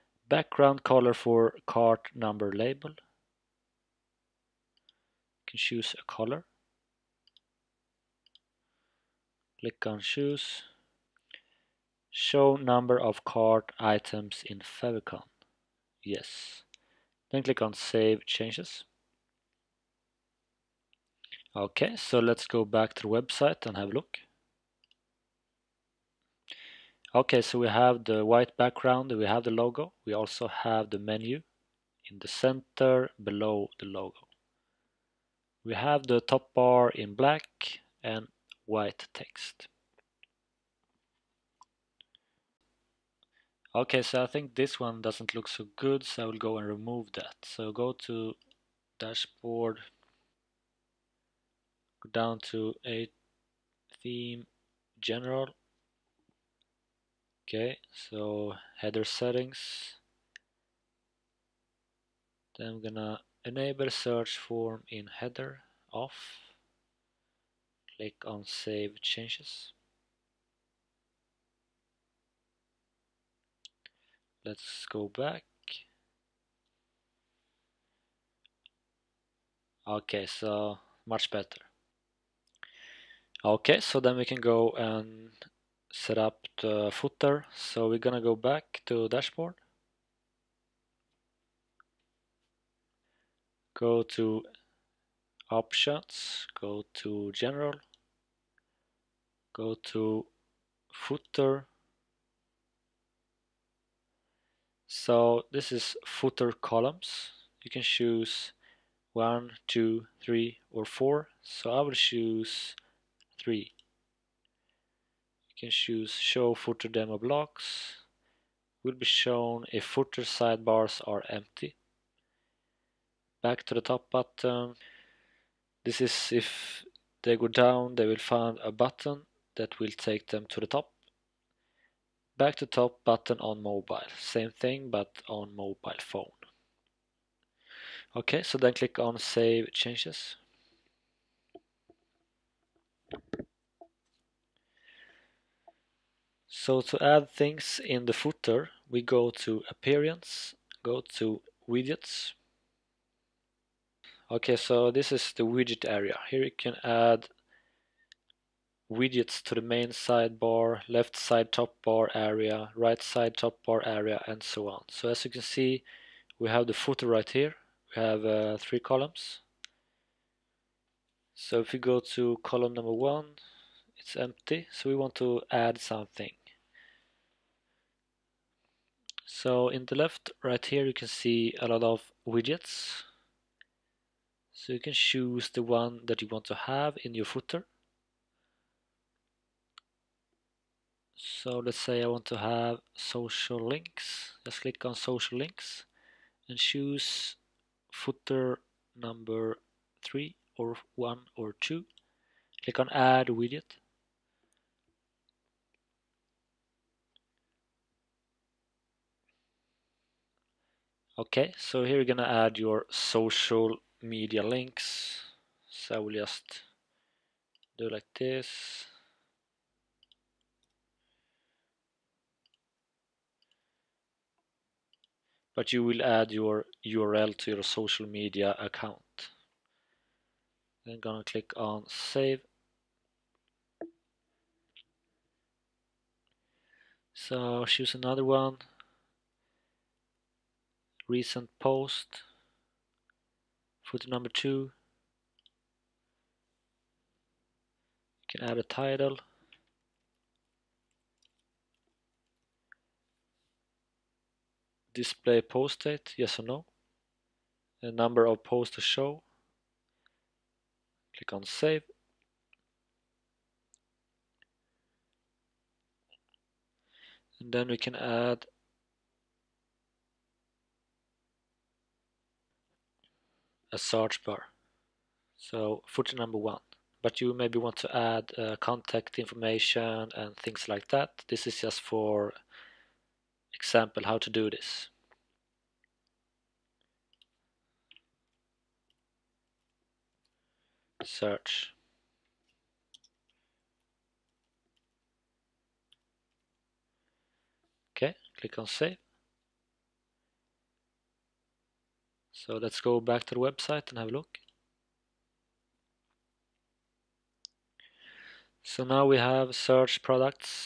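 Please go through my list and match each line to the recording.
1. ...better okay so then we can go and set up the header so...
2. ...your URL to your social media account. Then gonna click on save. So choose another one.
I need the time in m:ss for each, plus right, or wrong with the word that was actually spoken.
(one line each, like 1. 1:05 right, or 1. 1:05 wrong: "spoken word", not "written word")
1. 1:21 wrong: "footer", not "header"
2. 3:46 right.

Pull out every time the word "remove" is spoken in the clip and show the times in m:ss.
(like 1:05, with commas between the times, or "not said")
0:46.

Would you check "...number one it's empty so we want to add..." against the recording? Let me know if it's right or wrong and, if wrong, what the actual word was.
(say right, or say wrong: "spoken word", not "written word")
right.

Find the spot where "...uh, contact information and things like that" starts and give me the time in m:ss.
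4:38.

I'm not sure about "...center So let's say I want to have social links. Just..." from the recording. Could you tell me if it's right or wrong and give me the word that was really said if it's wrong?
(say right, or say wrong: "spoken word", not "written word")
wrong: "footer", not "center".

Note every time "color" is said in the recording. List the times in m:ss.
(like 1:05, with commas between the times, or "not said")
0:00, 0:06.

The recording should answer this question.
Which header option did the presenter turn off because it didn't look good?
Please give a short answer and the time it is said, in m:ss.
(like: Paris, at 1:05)
Search form in header, at 1:03.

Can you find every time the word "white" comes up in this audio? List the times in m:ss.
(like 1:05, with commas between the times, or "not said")
0:28, 0:38.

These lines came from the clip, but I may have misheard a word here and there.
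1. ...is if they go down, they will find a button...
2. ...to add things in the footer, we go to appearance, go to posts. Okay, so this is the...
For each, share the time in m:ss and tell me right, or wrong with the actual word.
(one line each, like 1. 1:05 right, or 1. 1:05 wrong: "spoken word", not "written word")
1. 2:06 right
2. 2:26 wrong: "widgets", not "posts".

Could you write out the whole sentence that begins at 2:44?
So as you can see we have the footer right here, we have uh, three columns.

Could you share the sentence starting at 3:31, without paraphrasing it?
Okay, so here you're gonna add your social media links.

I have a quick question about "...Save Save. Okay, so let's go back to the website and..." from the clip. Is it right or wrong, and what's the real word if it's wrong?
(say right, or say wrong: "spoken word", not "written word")
wrong: "Changes", not "Save".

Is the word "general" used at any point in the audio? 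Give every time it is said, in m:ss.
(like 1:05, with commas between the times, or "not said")
0:54, 1:37.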